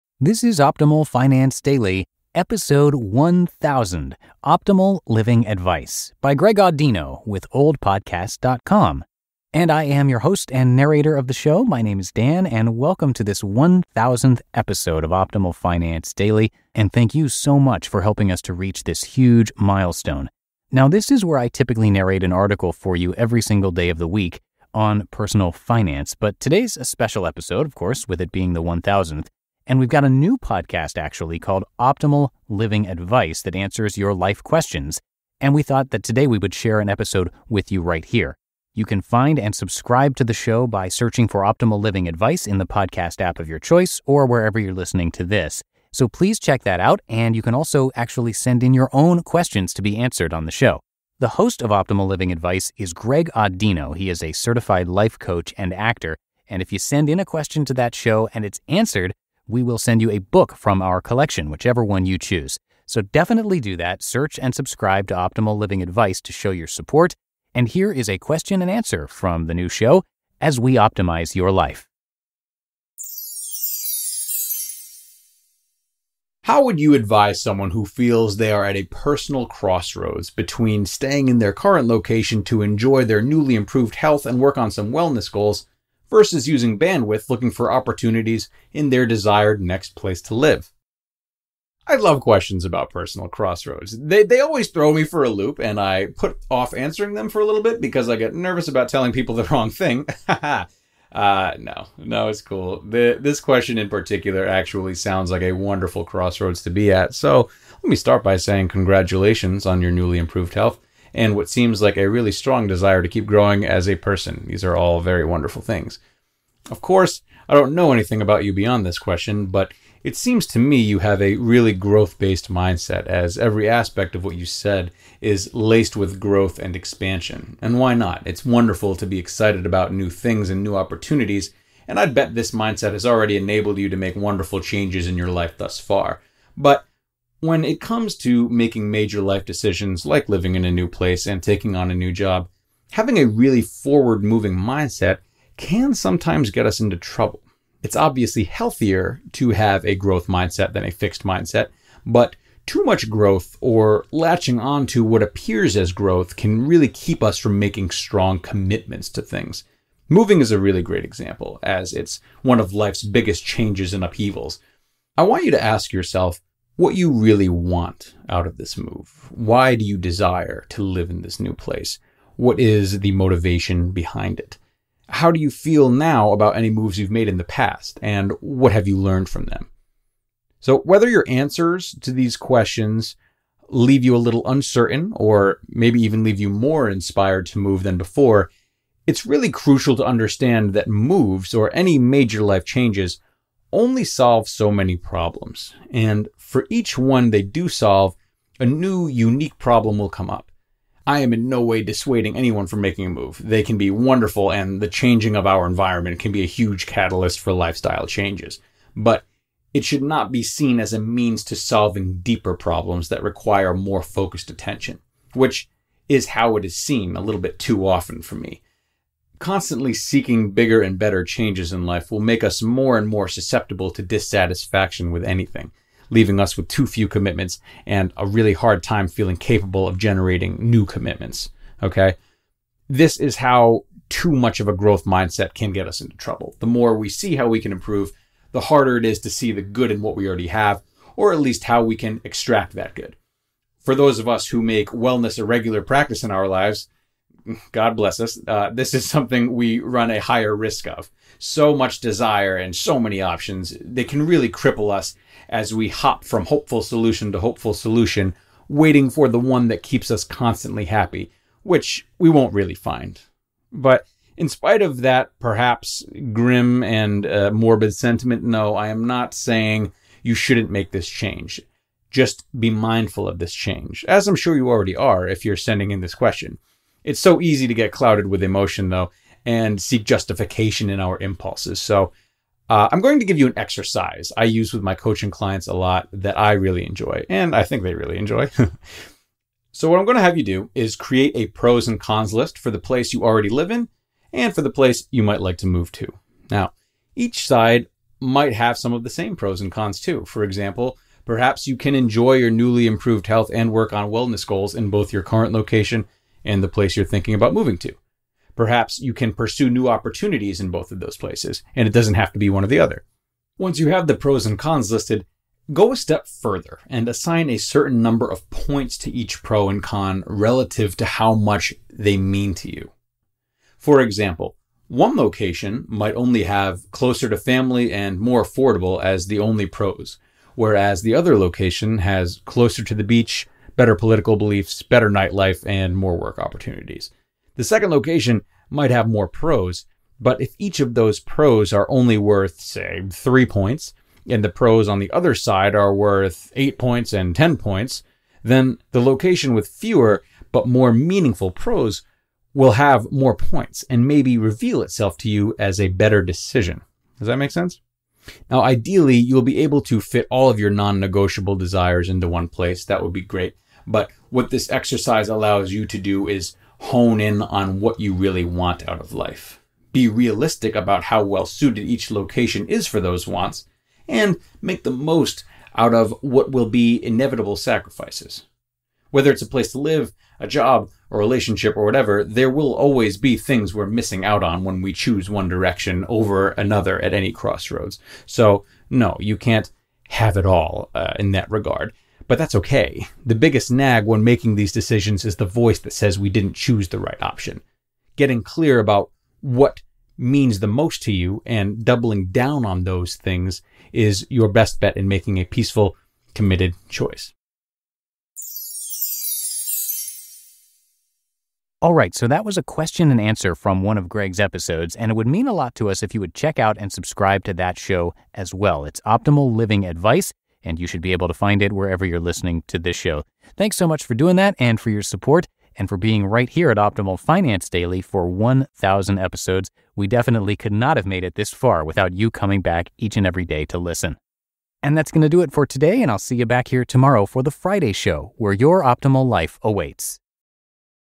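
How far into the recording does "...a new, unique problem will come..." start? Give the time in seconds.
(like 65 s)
198 s.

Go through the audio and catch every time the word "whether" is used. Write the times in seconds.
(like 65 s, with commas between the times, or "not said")
180 s, 379 s.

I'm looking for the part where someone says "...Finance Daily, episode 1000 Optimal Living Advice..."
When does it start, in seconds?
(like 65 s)
1 s.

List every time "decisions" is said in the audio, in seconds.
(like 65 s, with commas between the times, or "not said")
139 s, 356 s, 394 s.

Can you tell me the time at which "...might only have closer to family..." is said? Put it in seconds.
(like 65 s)
325 s.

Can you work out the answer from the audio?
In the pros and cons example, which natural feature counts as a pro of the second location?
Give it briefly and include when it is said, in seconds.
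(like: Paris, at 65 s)
The beach, at 332 s.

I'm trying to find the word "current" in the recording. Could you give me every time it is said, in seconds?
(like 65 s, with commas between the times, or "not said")
81 s, 305 s.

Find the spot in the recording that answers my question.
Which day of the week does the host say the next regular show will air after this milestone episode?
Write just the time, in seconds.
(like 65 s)
437 s.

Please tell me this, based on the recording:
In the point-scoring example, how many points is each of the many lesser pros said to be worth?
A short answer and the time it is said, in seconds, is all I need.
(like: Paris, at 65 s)
3, at 343 s.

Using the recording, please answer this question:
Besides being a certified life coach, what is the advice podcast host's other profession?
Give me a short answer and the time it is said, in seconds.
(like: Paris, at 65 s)
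Actor, at 55 s.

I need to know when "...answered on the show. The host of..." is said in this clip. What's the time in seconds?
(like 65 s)
49 s.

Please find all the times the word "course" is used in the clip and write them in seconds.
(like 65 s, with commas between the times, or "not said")
27 s, 116 s.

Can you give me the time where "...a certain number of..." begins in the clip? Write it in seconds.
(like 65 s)
317 s.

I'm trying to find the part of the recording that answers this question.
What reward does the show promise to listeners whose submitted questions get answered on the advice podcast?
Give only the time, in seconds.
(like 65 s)
60 s.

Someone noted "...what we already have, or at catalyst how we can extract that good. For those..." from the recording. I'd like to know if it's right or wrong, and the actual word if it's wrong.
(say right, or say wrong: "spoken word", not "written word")
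wrong: "least", not "catalyst".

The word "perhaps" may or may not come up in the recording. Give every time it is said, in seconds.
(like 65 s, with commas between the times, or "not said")
265 s, 301 s, 308 s.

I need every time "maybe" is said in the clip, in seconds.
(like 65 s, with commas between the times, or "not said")
185 s, 354 s.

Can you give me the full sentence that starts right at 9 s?
And I am your host and narrator of the show.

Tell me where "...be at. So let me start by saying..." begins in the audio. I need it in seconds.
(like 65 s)
106 s.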